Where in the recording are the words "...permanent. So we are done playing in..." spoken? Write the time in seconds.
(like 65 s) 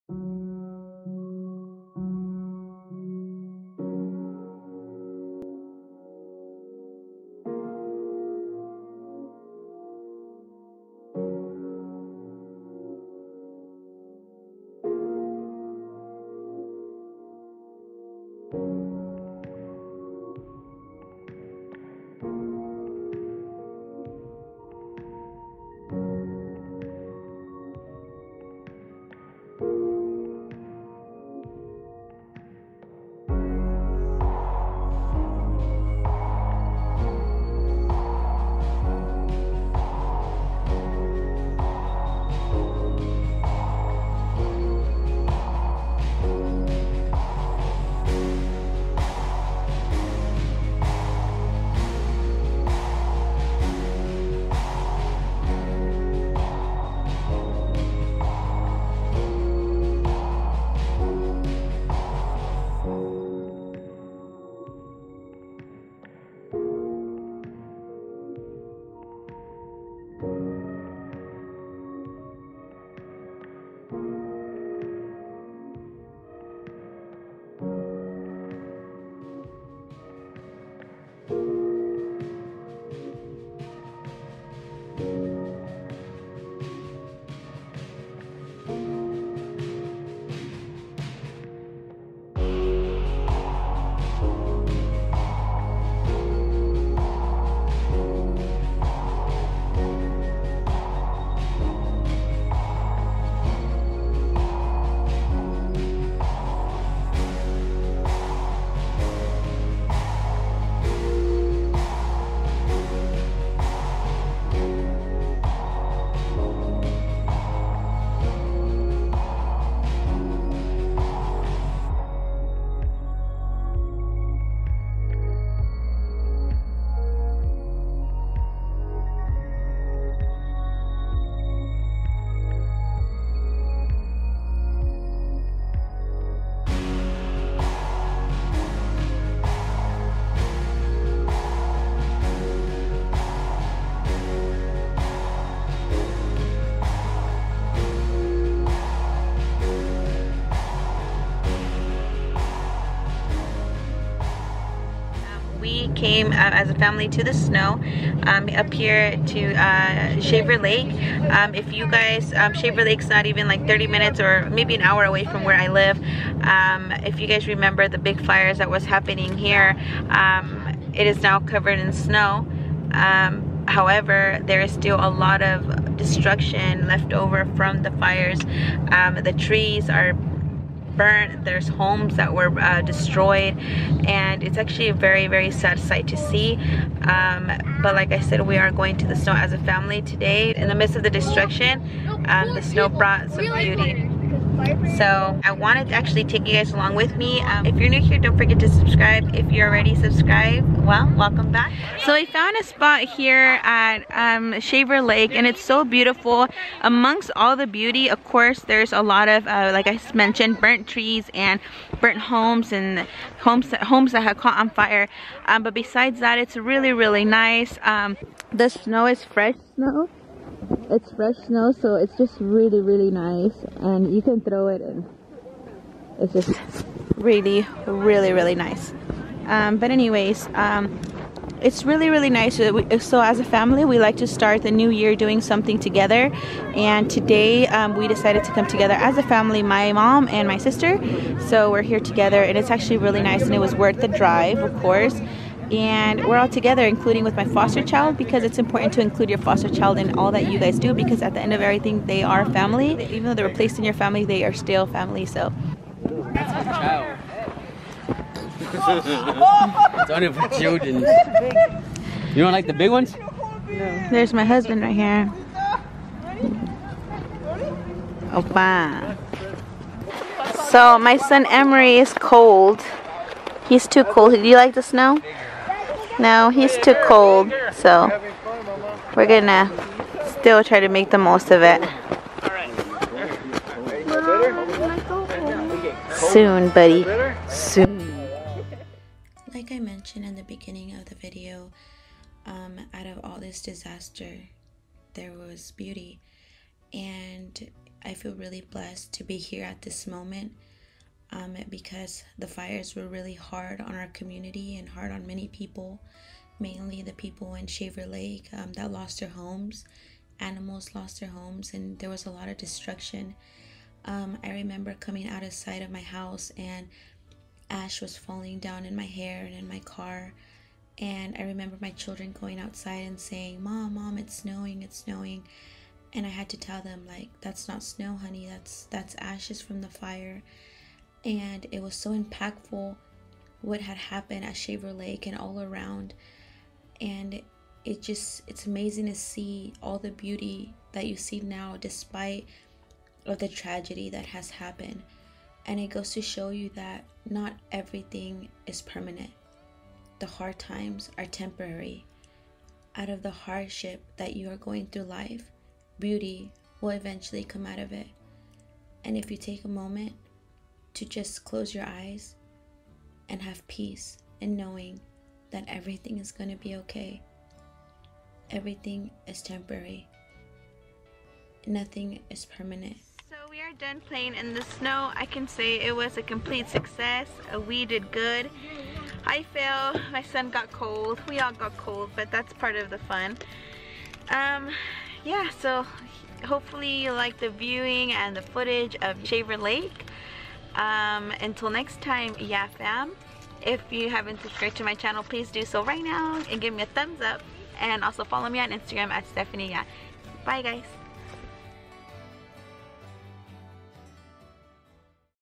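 372 s.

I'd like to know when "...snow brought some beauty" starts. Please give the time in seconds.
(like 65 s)
192 s.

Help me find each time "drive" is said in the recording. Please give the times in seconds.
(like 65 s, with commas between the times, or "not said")
244 s.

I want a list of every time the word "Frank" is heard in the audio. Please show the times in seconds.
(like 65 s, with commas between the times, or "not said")
not said.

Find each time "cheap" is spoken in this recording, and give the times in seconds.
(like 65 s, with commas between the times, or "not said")
not said.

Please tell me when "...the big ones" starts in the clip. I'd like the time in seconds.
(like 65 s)
262 s.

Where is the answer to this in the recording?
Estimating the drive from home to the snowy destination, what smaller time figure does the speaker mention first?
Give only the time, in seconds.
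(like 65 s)
163 s.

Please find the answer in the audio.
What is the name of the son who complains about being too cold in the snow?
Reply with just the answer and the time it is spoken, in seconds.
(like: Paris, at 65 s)
Emery, at 271 s.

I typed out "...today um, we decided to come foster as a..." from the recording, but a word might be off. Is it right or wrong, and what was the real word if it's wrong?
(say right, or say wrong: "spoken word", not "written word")
wrong: "together", not "foster".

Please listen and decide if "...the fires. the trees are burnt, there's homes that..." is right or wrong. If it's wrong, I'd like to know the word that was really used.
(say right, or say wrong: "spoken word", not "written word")
right.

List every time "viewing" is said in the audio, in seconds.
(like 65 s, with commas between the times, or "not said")
387 s.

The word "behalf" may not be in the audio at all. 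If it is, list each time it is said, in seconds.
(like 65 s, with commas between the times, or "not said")
not said.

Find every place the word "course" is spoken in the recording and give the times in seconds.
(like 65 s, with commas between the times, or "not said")
208 s, 244 s.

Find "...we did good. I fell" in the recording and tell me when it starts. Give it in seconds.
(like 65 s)
377 s.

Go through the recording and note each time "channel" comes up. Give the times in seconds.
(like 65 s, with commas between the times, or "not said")
394 s.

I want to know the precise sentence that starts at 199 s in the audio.
If you're already subscribed, well, welcome back.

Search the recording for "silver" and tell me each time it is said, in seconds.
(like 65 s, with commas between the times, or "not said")
not said.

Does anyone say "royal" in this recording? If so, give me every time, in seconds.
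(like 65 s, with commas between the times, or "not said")
not said.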